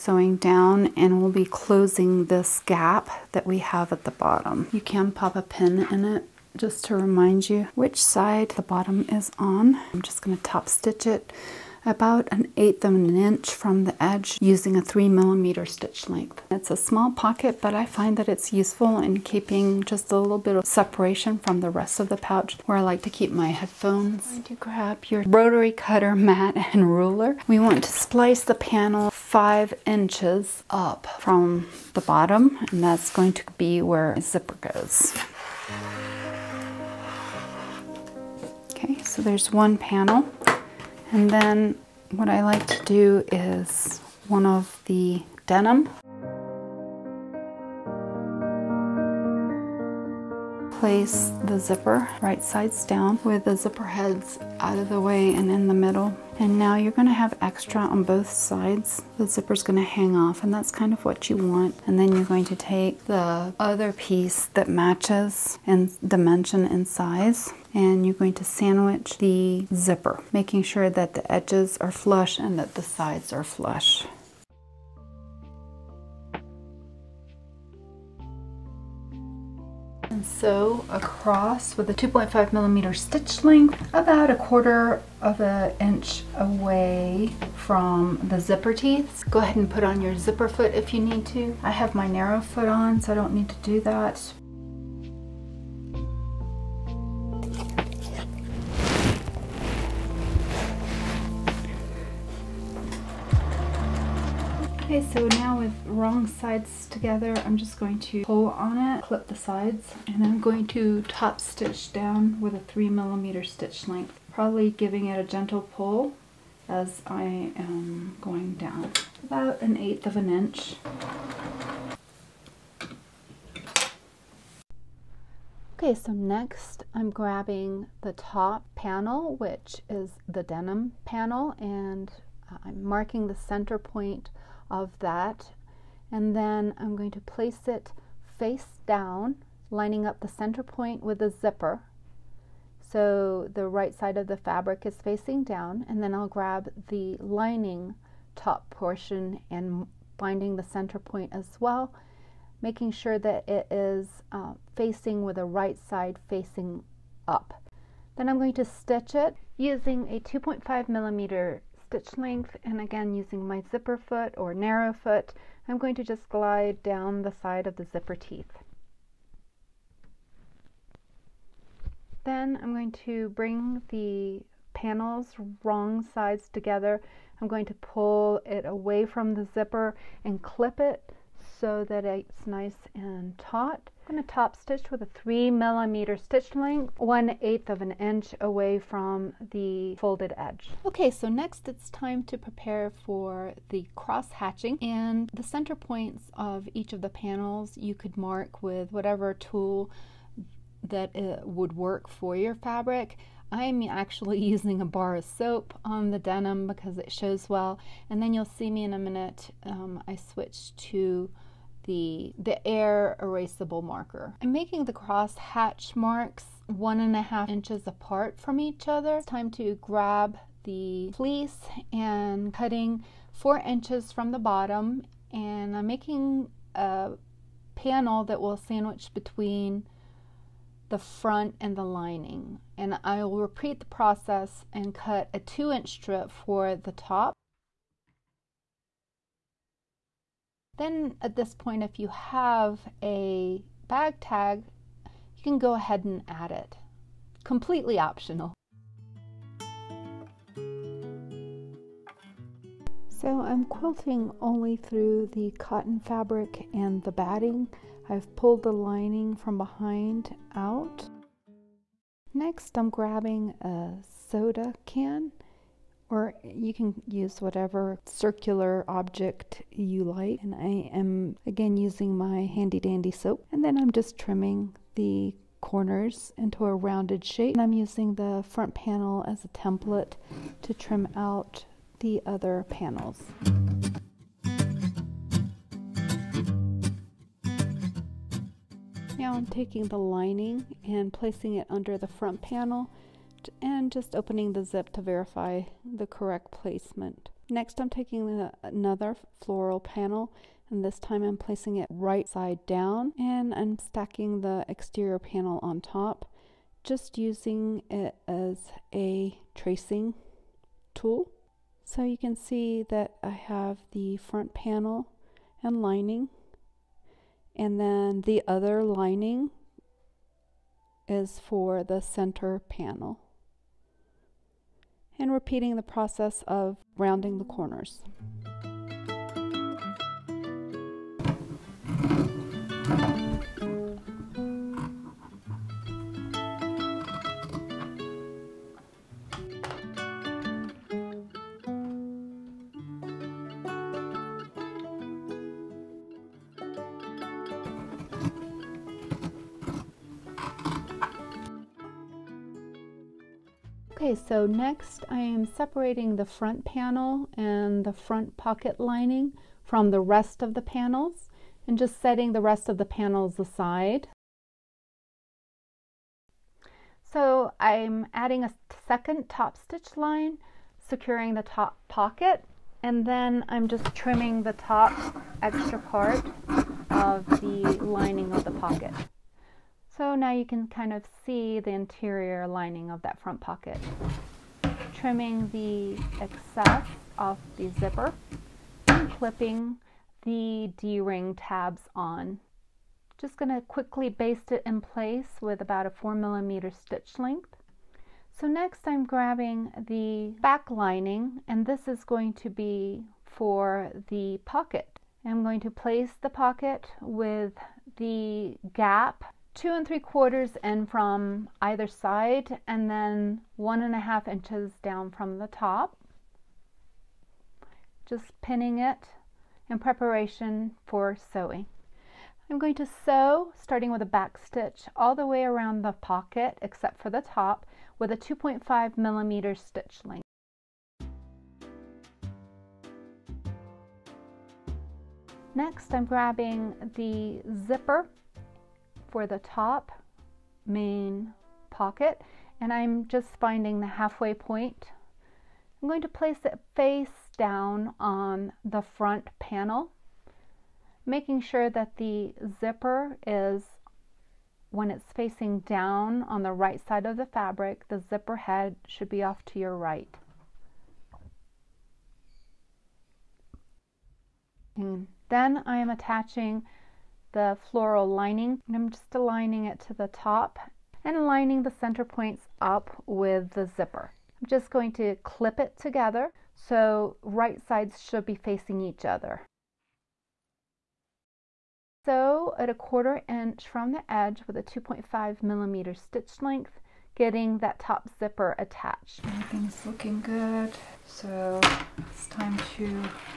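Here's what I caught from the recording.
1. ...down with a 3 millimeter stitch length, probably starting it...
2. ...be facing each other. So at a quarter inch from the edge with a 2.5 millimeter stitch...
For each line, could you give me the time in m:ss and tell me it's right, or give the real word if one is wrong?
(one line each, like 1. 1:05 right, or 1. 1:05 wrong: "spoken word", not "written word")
1. 1:51 wrong: "giving", not "starting"
2. 7:58 right.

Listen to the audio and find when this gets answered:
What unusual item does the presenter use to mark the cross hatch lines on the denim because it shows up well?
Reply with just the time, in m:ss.
3:24.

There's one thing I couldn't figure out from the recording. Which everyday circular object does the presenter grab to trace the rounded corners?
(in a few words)
soda can.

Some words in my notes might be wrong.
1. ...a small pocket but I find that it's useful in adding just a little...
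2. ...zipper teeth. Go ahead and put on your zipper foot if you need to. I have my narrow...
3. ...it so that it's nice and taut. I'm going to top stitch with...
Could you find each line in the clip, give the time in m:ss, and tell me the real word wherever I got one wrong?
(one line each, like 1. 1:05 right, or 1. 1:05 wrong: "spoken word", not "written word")
1. 0:16 wrong: "keeping", not "adding"
2. 1:28 right
3. 3:00 right.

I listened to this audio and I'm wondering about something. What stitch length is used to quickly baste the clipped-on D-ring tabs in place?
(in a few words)
4 millimeters.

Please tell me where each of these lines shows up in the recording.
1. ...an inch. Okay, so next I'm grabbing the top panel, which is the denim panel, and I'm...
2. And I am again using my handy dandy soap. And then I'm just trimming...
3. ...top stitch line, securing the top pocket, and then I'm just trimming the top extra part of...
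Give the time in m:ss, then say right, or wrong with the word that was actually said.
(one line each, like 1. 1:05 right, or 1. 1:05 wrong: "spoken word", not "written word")
1. 2:00 right
2. 4:30 right
3. 6:09 right.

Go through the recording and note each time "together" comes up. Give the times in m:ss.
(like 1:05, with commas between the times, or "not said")
1:46, 2:56, 7:55.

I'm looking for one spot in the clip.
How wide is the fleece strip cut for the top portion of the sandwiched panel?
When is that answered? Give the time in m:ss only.
3:55.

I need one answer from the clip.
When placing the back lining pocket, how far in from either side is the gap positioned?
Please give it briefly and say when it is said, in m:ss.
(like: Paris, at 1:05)
2 3/4 inches, at 6:49.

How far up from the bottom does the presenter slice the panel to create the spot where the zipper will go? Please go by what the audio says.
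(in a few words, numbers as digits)
5 inches.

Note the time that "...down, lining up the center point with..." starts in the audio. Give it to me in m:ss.
2:18.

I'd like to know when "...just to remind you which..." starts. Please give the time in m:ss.
0:06.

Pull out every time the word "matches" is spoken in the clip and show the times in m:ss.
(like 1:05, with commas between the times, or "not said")
1:04.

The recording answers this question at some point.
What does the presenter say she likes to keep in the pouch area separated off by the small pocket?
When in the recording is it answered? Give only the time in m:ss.
0:23.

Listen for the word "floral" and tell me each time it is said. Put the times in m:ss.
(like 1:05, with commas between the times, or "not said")
4:59, 7:47.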